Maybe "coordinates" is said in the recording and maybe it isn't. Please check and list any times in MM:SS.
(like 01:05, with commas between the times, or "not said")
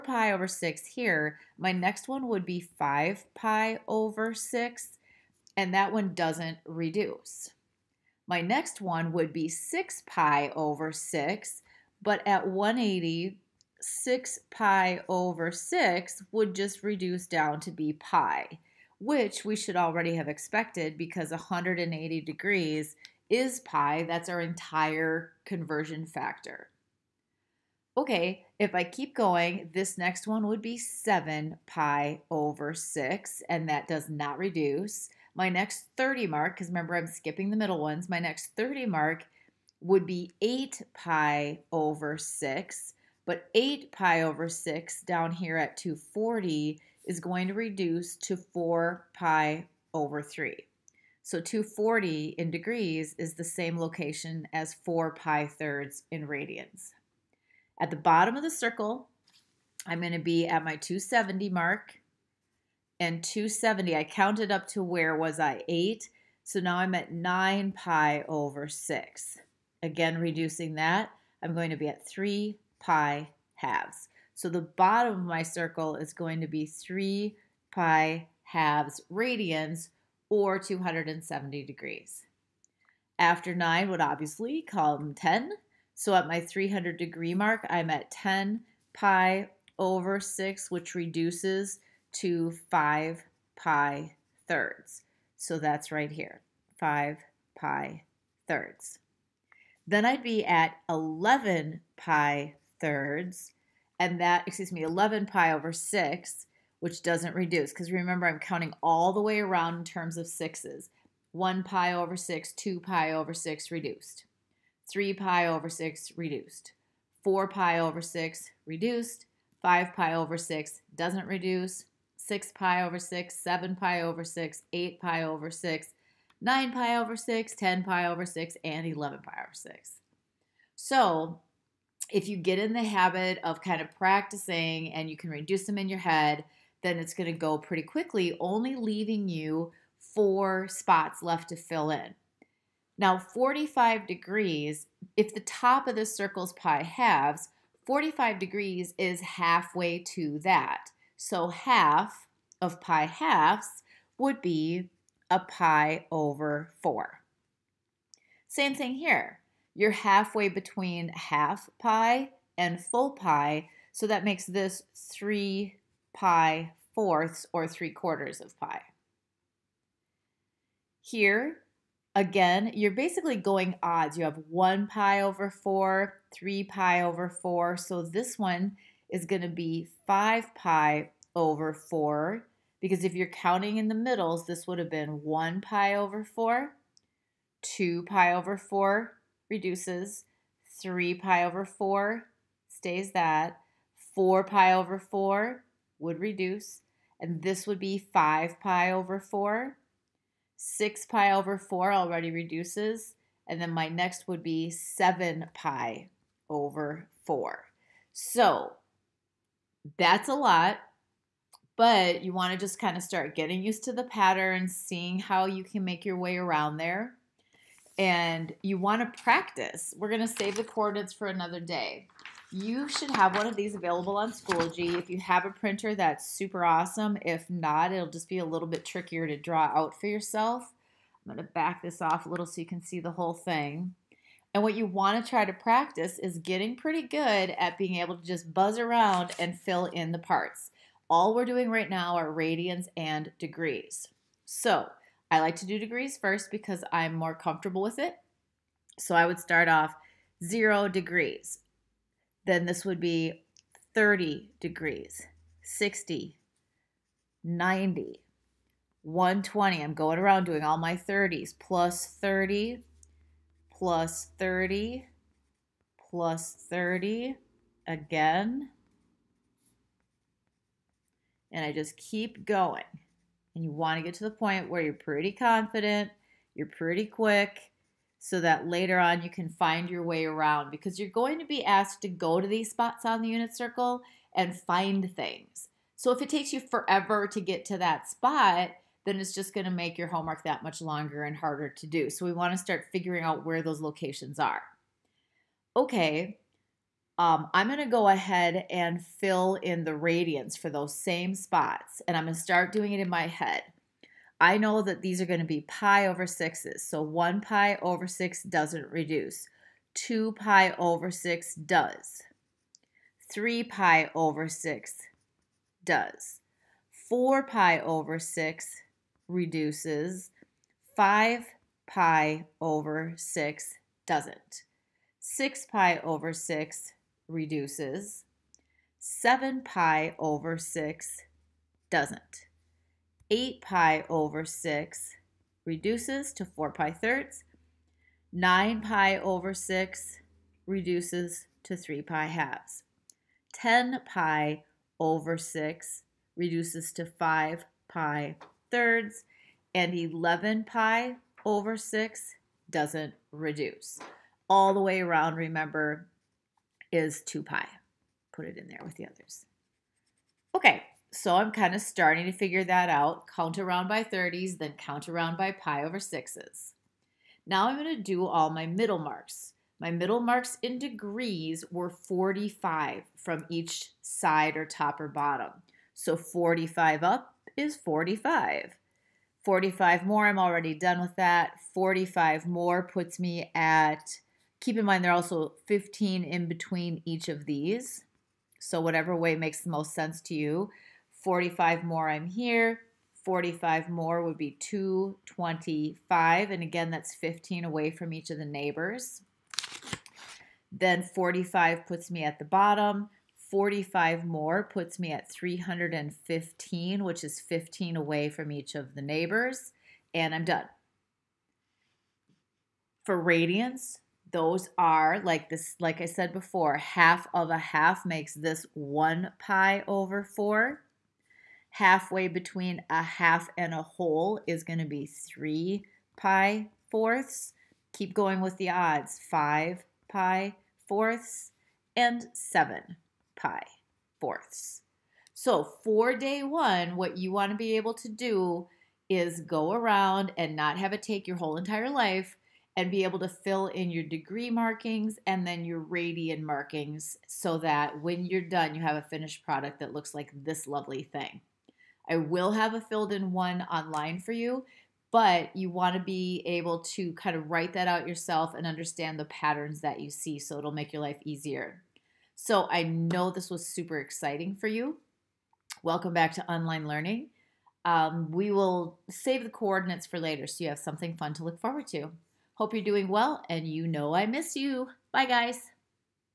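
03:40, 07:49.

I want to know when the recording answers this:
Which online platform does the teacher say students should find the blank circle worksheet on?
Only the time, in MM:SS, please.
03:44.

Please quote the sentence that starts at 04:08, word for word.
So I would start off zero degrees.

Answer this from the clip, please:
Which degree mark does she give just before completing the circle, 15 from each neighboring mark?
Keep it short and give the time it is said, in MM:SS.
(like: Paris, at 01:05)
315, at 06:45.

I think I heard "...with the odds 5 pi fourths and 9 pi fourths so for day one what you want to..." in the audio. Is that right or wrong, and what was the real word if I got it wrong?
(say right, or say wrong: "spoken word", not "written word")
wrong: "7", not "9".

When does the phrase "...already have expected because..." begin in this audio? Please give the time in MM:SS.
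00:19.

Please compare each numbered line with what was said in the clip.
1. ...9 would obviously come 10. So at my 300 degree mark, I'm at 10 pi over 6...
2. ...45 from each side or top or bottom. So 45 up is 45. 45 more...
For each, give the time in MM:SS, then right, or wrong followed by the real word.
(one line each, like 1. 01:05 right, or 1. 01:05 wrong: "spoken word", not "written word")
1. 01:23 right
2. 06:11 right.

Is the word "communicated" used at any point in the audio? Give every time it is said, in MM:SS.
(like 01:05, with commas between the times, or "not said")
not said.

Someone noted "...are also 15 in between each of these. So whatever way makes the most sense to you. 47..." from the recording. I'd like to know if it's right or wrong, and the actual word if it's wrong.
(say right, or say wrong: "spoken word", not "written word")
wrong: "45", not "47".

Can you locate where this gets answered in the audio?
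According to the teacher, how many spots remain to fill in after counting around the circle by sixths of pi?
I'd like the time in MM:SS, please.
02:19.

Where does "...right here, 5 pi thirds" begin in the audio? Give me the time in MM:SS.
01:35.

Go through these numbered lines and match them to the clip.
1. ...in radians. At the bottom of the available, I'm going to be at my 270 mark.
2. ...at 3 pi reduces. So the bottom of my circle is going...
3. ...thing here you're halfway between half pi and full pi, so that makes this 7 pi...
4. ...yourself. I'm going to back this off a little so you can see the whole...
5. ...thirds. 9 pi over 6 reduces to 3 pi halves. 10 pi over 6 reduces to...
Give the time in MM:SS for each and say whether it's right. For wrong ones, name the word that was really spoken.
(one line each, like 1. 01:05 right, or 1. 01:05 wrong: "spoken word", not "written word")
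1. 00:56 wrong: "circle", not "available"
2. 01:11 wrong: "halves", not "reduces"
3. 02:38 wrong: "3", not "7"
4. 03:50 right
5. 05:36 right.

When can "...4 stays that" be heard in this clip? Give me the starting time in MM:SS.
03:11.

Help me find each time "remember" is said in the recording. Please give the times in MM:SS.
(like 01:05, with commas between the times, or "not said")
00:36, 01:47, 05:55.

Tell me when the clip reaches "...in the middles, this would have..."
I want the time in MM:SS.
03:03.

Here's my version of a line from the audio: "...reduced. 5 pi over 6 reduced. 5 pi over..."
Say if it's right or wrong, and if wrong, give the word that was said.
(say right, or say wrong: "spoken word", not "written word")
wrong: "4", not "5".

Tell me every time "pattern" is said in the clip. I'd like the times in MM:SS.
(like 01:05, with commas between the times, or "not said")
03:34, 07:39.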